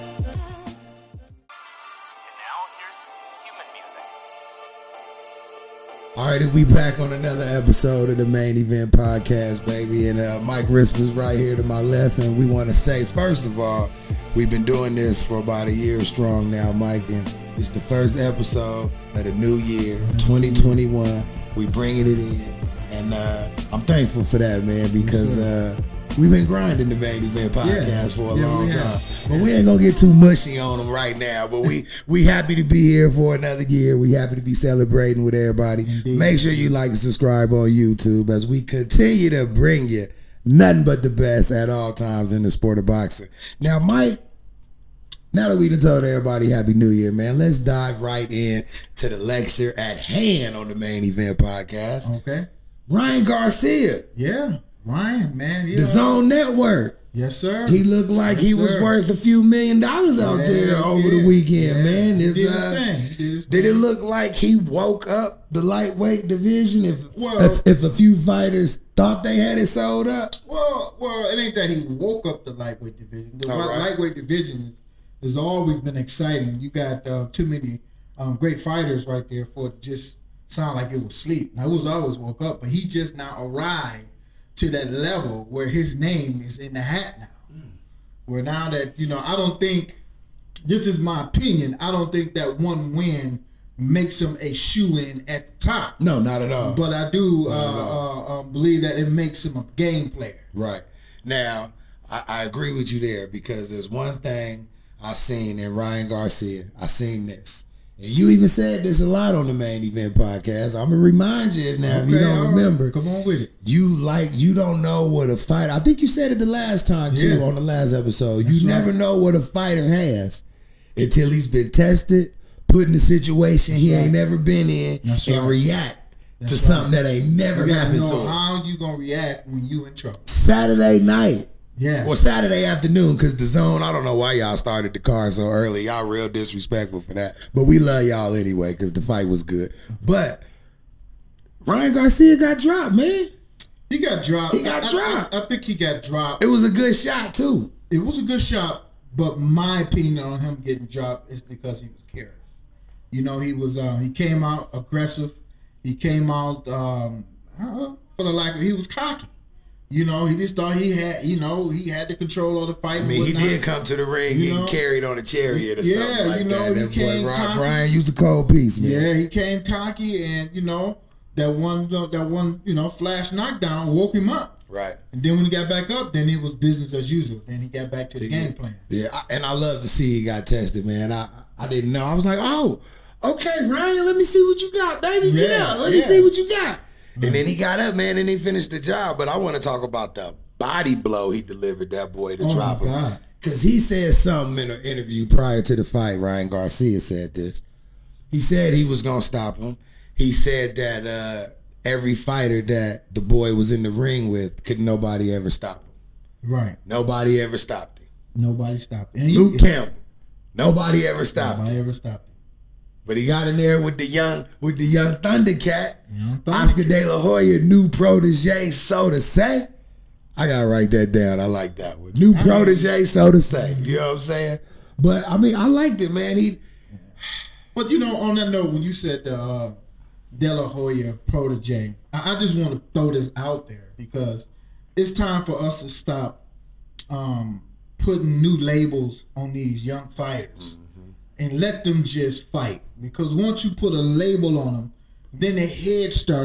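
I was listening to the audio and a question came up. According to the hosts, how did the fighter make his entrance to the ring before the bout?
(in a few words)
On a chariot.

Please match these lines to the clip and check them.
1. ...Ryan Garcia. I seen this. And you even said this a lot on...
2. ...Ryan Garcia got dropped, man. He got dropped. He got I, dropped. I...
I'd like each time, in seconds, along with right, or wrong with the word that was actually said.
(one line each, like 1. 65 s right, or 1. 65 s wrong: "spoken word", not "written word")
1. 105 s right
2. 141 s right.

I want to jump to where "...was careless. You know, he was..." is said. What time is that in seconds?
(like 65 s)
151 s.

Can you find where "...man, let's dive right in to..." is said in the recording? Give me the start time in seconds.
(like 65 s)
47 s.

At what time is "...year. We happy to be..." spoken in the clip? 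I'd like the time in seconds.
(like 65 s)
33 s.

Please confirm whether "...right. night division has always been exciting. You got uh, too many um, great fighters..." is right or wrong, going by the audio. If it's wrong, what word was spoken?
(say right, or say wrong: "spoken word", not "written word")
wrong: "lightweight", not "night".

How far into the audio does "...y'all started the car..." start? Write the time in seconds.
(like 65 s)
134 s.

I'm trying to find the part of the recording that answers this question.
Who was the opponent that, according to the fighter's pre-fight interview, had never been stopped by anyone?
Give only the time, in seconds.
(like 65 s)
209 s.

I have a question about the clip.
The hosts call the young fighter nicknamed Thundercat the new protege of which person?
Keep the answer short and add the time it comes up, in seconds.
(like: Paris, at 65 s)
Oscar De La Hoya, at 216 s.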